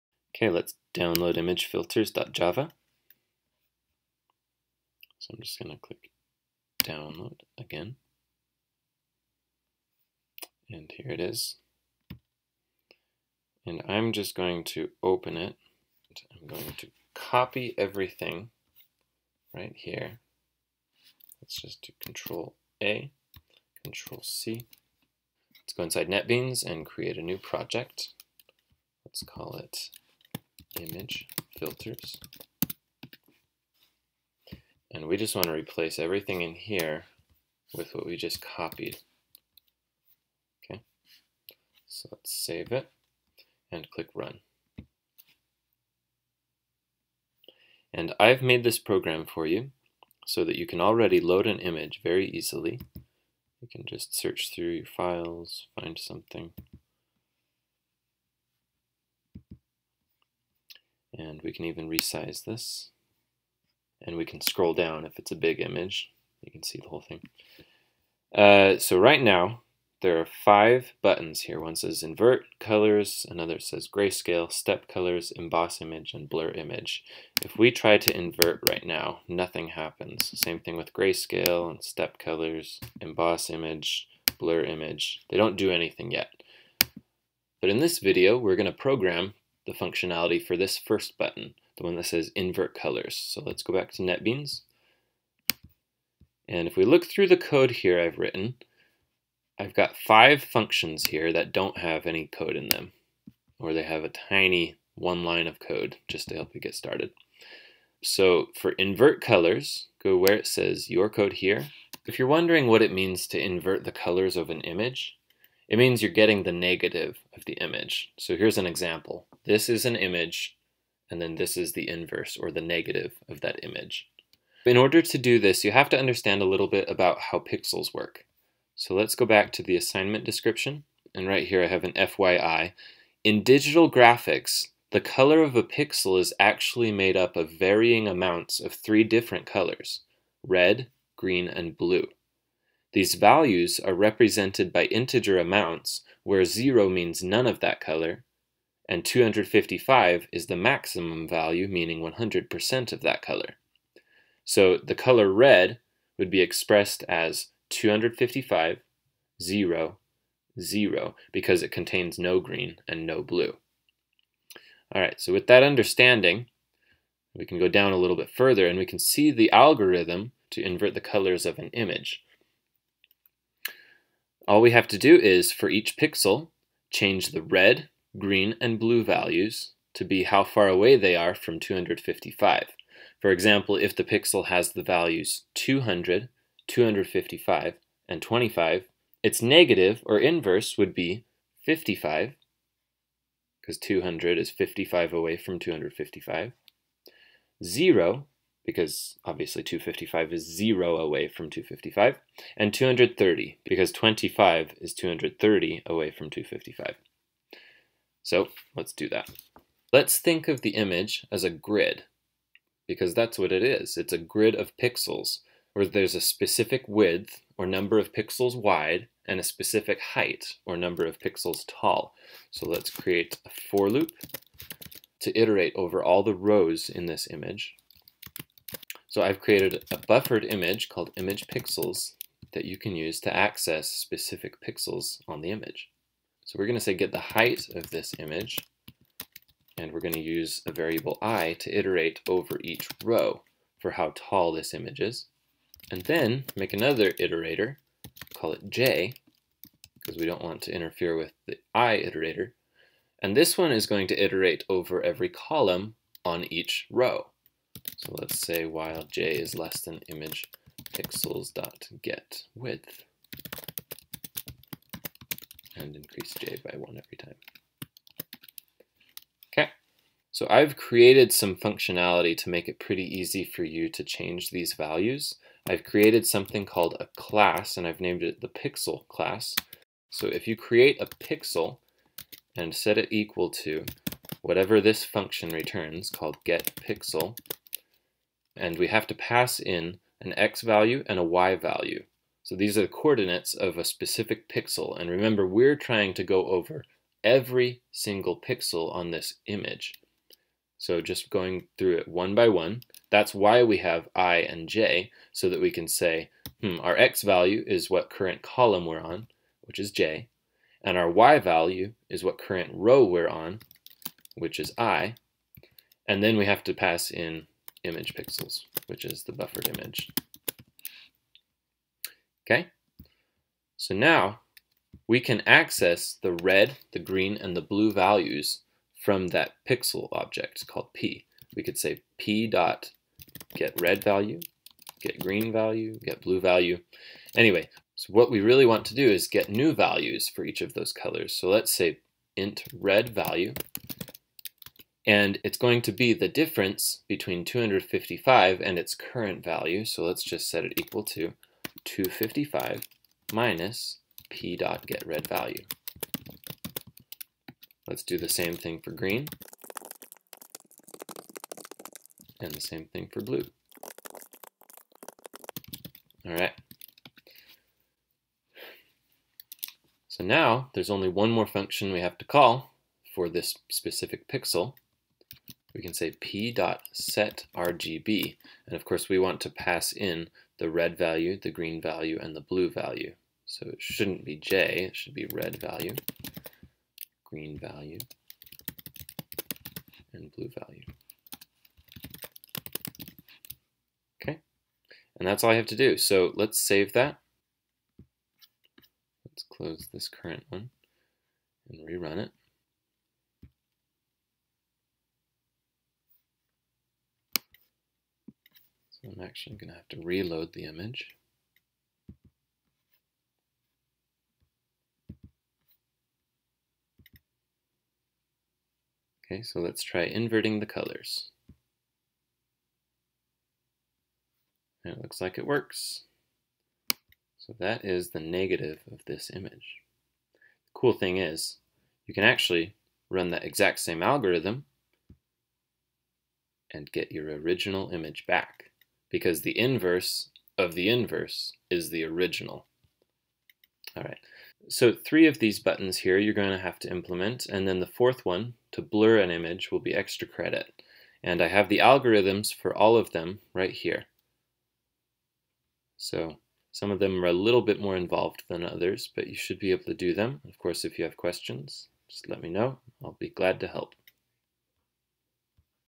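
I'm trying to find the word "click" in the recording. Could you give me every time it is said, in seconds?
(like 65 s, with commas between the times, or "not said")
5 s, 43 s.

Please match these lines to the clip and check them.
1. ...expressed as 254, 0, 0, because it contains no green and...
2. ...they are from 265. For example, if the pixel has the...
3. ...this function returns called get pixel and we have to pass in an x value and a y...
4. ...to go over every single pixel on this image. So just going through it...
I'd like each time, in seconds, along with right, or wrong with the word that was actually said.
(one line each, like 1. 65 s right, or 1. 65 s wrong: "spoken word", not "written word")
1. 156 s wrong: "255", not "254"
2. 180 s wrong: "255", not "265"
3. 284 s right
4. 296 s right.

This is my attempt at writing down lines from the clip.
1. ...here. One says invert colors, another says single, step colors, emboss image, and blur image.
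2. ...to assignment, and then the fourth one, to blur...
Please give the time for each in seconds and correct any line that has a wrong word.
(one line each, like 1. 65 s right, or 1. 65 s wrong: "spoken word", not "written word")
1. 71 s wrong: "grayscale", not "single"
2. 446 s wrong: "implement", not "assignment".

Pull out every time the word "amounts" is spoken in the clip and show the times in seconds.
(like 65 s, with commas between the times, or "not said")
138 s, 145 s.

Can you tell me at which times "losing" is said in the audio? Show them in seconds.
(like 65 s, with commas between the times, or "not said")
not said.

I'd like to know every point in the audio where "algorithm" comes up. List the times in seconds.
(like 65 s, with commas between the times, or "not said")
169 s, 434 s, 451 s.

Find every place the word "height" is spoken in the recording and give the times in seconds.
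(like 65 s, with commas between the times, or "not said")
219 s, 237 s.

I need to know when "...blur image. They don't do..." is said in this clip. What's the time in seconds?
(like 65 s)
84 s.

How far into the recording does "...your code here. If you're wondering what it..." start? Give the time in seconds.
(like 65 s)
110 s.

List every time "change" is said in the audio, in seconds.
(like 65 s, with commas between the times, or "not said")
176 s, 274 s.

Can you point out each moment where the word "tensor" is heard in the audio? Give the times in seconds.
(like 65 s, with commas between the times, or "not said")
not said.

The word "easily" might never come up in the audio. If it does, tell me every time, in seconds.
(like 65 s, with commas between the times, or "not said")
52 s.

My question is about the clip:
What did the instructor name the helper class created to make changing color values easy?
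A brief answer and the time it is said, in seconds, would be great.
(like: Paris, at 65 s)
pixel class, at 278 s.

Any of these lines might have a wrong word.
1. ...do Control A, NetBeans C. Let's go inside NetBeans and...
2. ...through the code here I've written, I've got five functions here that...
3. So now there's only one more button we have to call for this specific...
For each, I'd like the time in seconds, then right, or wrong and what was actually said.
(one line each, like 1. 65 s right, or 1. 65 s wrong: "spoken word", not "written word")
1. 21 s wrong: "Control", not "NetBeans"
2. 97 s right
3. 370 s wrong: "function", not "button".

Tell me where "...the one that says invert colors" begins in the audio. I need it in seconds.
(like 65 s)
91 s.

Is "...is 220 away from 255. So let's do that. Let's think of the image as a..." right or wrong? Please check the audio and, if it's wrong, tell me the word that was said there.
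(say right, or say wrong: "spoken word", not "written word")
wrong: "230", not "220".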